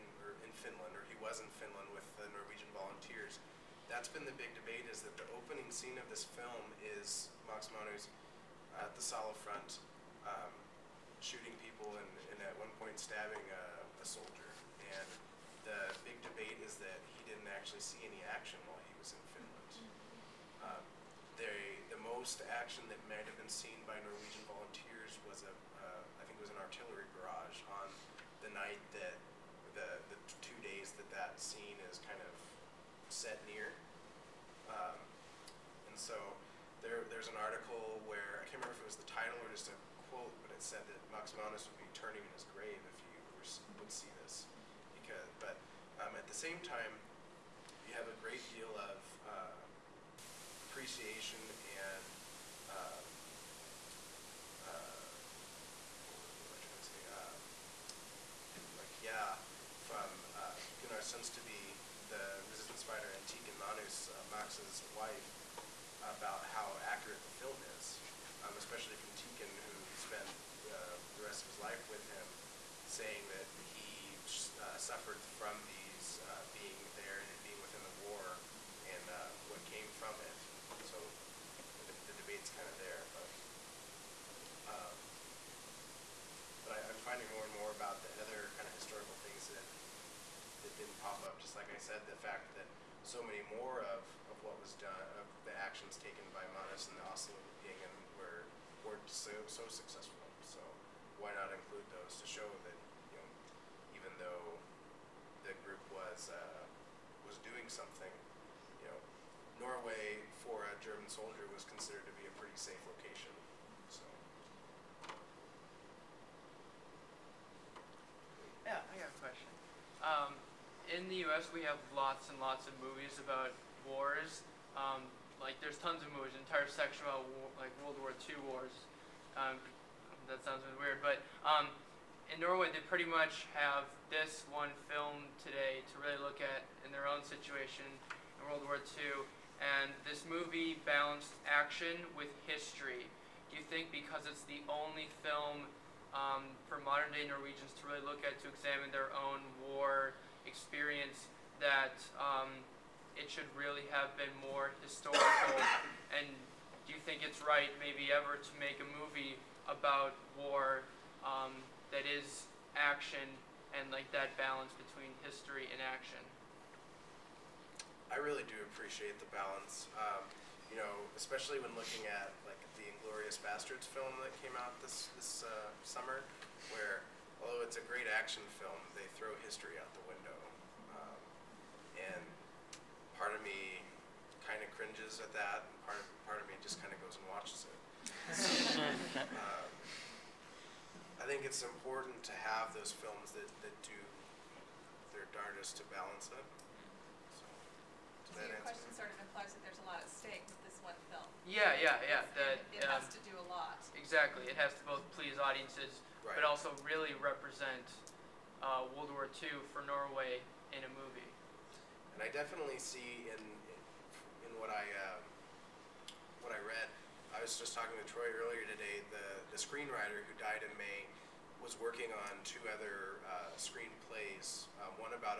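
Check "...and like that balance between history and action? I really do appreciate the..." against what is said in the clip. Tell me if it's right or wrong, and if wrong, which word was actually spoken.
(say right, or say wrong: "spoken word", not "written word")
right.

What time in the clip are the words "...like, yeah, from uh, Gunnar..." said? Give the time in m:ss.
0:58.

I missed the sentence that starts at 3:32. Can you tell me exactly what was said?
And I definitely see in in what I uh, what I read.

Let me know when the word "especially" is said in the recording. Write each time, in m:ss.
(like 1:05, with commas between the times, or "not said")
1:08, 2:51.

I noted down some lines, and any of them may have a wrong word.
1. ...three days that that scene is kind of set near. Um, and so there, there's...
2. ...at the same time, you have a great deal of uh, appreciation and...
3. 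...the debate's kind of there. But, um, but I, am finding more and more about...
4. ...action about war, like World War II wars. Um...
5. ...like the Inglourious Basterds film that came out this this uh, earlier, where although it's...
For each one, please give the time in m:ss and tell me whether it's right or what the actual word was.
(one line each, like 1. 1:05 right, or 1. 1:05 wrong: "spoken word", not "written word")
1. 0:30 wrong: "two", not "three"
2. 0:46 right
3. 1:22 right
4. 2:06 wrong: "section", not "action"
5. 2:52 wrong: "summer", not "earlier".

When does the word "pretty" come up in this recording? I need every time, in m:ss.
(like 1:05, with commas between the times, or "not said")
1:52, 2:12.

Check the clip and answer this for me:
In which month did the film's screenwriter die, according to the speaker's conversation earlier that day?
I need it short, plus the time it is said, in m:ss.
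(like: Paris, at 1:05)
May, at 3:40.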